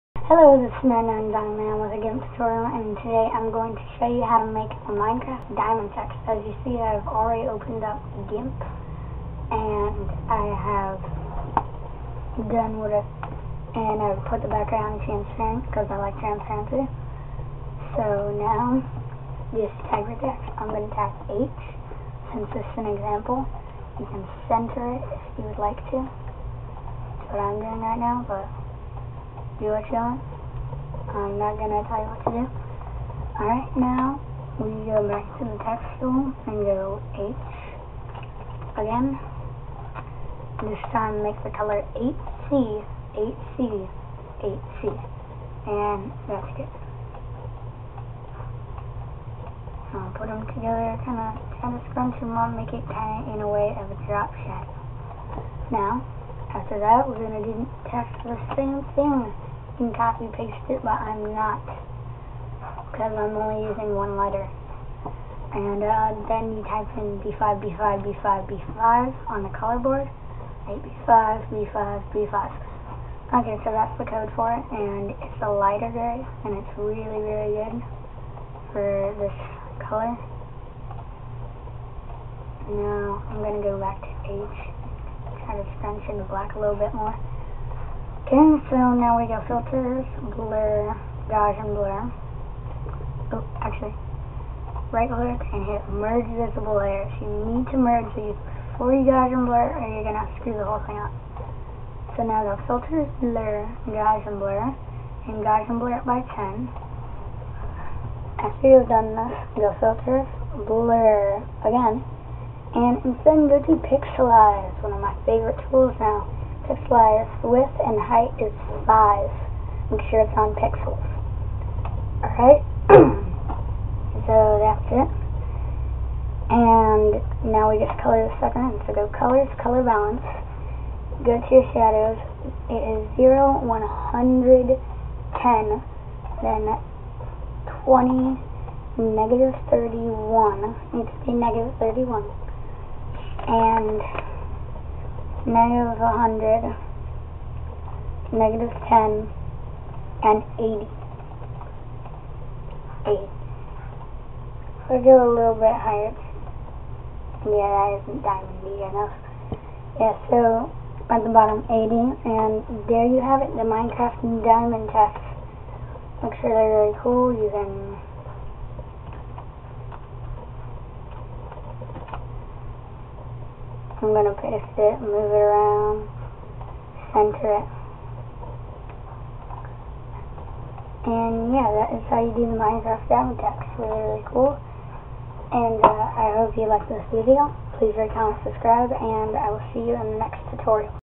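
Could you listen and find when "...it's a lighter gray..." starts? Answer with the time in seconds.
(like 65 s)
75 s.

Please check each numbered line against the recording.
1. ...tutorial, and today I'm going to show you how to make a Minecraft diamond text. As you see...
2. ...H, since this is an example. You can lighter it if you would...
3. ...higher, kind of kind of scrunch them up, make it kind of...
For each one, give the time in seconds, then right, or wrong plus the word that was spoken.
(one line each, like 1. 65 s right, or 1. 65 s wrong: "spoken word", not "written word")
1. 2 s right
2. 21 s wrong: "center", not "lighter"
3. 50 s wrong: "together", not "higher".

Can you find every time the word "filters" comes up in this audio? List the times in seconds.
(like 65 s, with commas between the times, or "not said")
89 s, 102 s, 109 s.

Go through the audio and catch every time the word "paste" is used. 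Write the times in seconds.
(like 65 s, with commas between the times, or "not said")
60 s, 174 s.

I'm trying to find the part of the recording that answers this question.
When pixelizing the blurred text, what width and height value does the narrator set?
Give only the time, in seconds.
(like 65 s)
118 s.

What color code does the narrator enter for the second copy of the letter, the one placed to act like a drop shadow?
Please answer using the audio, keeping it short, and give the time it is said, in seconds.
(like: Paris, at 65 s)
8C8C8C, at 41 s.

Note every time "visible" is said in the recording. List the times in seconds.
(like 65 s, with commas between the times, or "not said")
96 s.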